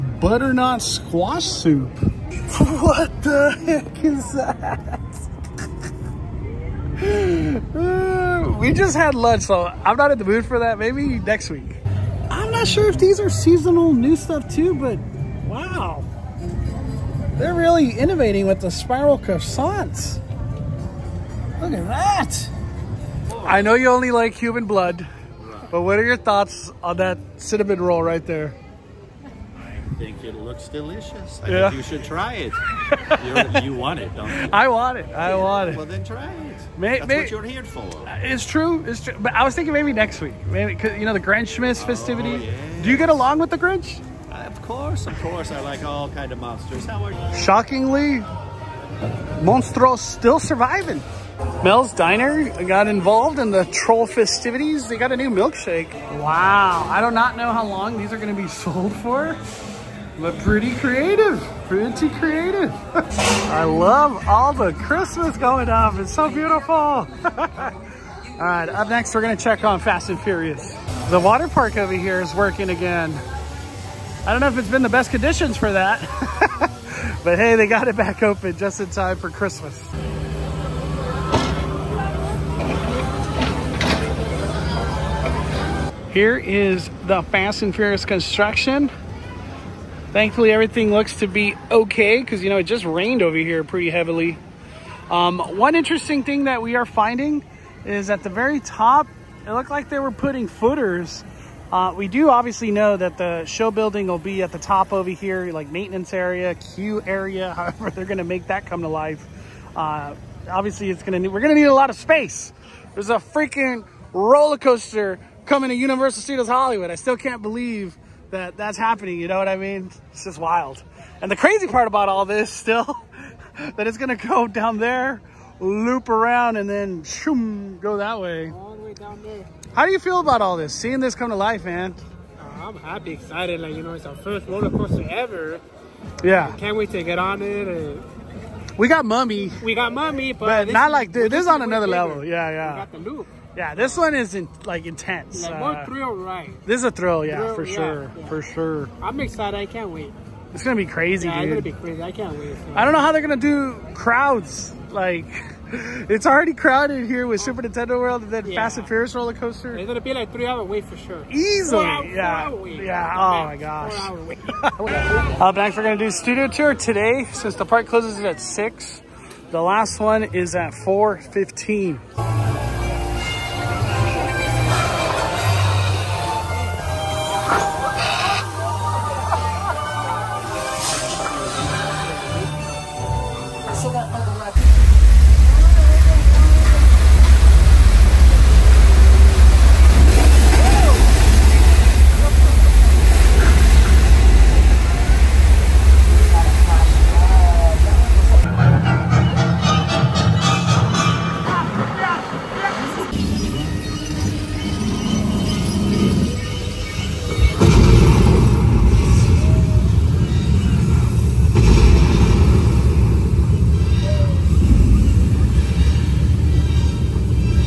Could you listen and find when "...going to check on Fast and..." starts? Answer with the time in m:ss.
1:09.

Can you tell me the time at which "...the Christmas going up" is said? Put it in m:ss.
1:04.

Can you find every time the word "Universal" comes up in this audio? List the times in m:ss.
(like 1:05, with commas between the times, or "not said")
1:55.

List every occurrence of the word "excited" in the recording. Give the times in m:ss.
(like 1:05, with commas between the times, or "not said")
2:13, 2:29.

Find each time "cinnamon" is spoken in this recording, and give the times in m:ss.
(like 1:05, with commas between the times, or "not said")
0:27.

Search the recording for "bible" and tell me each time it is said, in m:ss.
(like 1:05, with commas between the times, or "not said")
not said.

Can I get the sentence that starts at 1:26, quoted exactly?
Here is the Fast and Furious construction.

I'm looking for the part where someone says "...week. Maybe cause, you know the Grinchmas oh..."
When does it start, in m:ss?
0:40.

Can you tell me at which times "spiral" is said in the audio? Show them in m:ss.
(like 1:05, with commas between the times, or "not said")
0:18.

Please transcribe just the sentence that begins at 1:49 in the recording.
Uh, obviously, it's going to we're going to need a lot of space.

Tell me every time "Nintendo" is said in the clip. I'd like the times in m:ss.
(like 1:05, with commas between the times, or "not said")
2:37.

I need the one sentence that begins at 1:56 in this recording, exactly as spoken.
I still can't believe that that's happening.